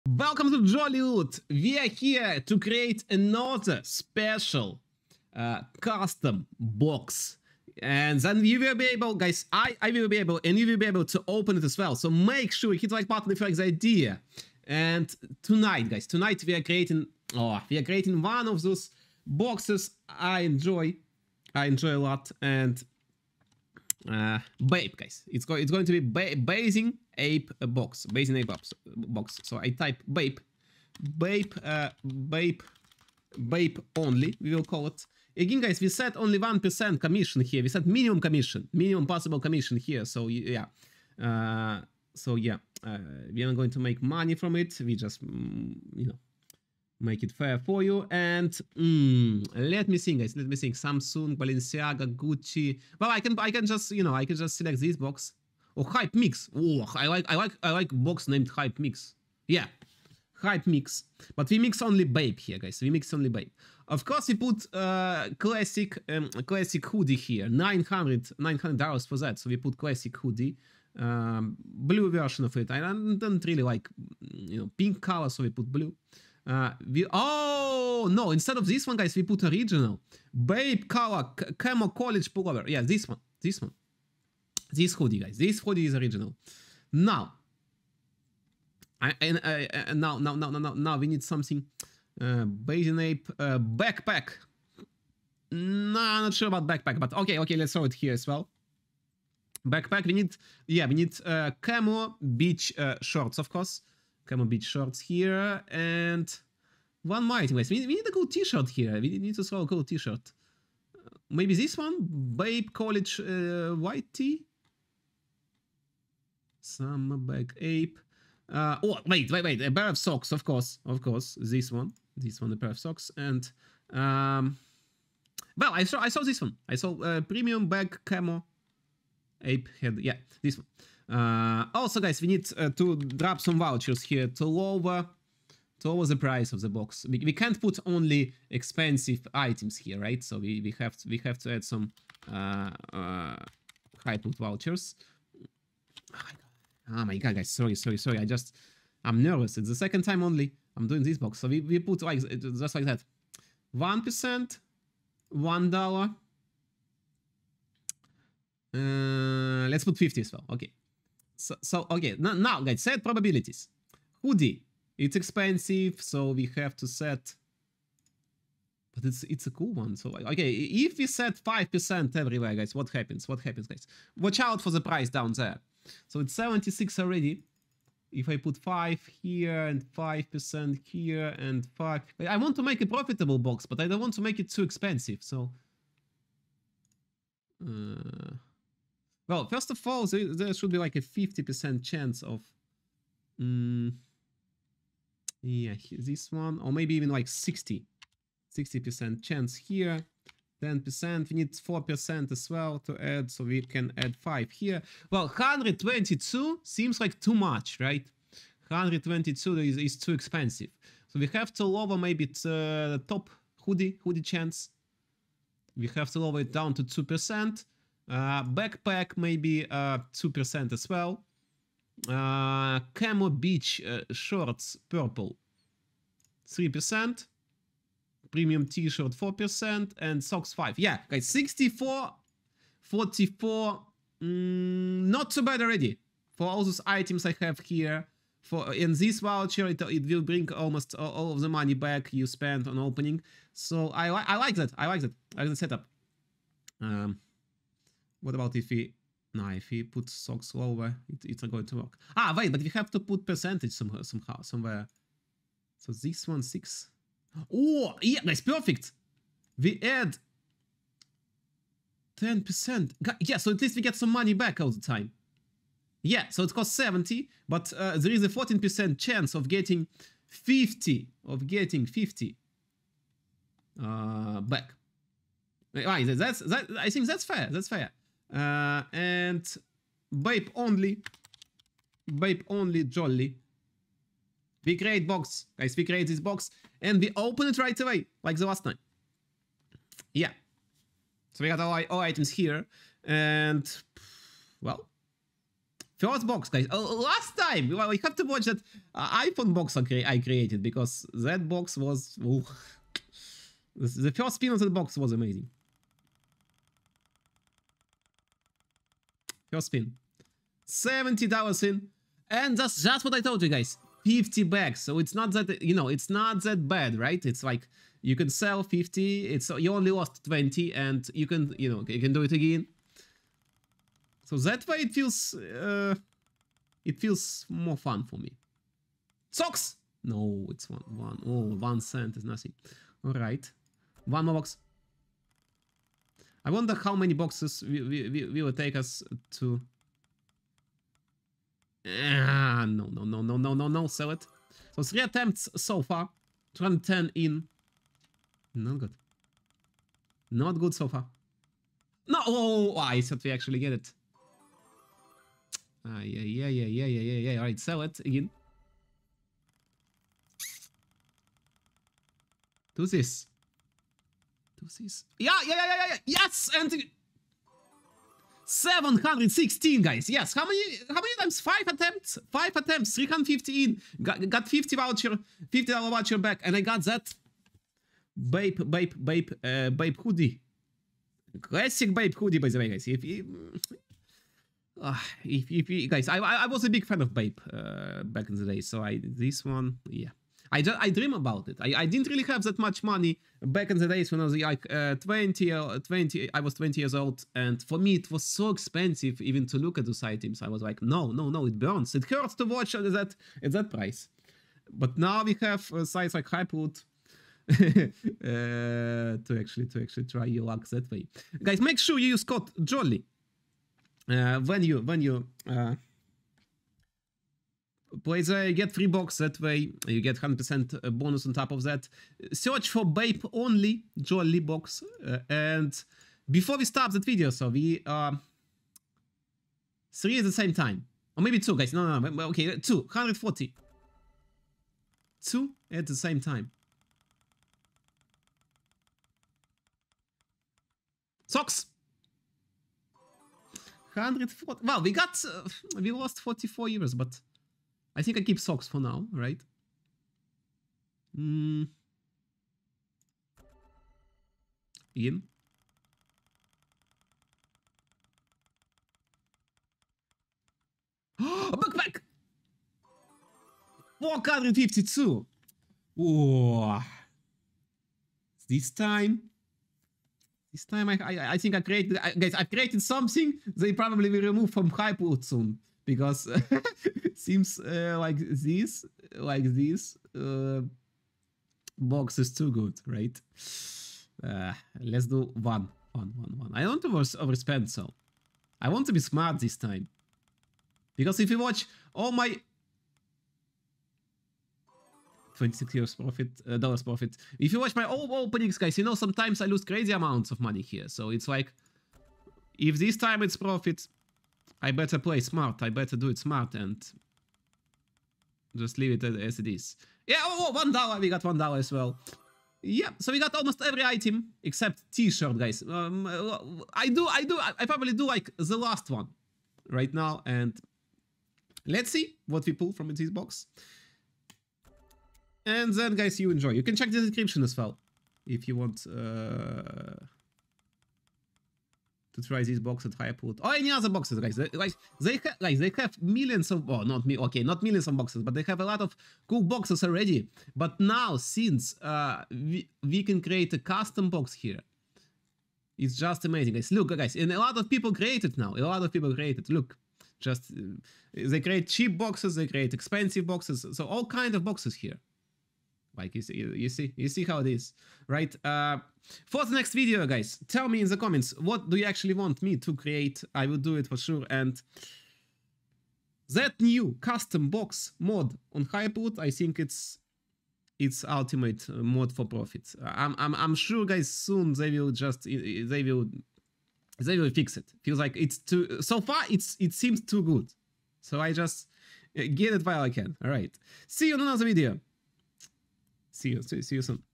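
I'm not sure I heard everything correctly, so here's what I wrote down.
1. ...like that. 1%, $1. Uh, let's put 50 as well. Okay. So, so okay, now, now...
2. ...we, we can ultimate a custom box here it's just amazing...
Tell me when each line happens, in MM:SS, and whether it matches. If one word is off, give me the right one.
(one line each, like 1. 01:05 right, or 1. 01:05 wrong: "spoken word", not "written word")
1. 02:32 right
2. 09:02 wrong: "create", not "ultimate".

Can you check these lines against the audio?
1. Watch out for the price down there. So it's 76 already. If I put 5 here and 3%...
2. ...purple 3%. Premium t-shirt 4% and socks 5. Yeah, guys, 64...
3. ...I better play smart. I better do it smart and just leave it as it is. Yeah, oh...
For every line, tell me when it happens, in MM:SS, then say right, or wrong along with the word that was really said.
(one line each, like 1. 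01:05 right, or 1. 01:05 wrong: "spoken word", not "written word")
1. 02:54 wrong: "5", not "3"
2. 03:44 right
3. 08:24 right.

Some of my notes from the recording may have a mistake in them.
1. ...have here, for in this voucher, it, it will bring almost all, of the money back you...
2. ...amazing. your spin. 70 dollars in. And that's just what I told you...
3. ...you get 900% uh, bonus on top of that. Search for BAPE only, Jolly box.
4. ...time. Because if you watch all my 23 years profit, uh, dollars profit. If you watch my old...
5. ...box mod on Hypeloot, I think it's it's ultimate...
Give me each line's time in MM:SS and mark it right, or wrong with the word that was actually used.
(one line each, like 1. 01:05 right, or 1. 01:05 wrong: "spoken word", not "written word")
1. 03:57 right
2. 05:05 right
3. 06:59 wrong: "100", not "900"
4. 08:09 wrong: "26", not "23"
5. 09:27 right.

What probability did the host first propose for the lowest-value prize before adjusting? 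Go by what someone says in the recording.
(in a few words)
60%.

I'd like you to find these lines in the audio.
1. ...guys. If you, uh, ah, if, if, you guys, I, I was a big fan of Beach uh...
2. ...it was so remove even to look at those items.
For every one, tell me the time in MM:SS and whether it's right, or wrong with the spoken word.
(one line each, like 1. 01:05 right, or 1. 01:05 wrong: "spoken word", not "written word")
1. 06:22 wrong: "BAPE", not "Beach"
2. 06:37 wrong: "expensive", not "remove".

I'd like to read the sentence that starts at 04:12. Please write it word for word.
Ah, wait, but we have to put percentage somehow, somehow somewhere.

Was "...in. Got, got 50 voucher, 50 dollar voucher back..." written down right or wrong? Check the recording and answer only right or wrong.
right.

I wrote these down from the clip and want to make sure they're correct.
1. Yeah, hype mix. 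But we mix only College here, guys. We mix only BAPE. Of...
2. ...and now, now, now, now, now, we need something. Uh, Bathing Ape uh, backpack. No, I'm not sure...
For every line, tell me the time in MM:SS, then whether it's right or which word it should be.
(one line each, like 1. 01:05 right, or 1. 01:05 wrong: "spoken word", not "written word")
1. 00:59 wrong: "BAPE", not "College"
2. 01:29 right.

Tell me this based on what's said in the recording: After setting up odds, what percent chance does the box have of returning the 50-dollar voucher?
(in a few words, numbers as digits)
14%.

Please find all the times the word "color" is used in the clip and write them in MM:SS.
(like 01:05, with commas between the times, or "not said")
01:15, 01:20.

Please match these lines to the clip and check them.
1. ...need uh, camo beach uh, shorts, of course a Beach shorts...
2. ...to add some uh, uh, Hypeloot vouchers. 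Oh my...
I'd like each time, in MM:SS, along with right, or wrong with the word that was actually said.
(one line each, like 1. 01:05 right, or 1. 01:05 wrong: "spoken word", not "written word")
1. 01:40 right
2. 02:21 right.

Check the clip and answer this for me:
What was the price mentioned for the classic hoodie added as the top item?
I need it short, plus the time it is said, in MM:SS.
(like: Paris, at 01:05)
$900, at 01:07.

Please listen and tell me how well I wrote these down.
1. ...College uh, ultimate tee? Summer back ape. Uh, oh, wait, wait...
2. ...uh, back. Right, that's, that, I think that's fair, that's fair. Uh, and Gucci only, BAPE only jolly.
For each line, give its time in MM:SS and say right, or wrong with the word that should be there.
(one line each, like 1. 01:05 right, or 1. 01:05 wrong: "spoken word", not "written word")
1. 01:52 wrong: "white", not "ultimate"
2. 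04:33 wrong: "BAPE", not "Gucci".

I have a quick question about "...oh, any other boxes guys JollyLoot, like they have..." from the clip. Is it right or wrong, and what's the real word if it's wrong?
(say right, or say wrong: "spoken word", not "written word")
wrong: "Guys", not "JollyLoot".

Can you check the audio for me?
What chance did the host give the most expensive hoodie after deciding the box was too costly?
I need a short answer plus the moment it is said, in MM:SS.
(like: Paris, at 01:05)
2%, at 03:36.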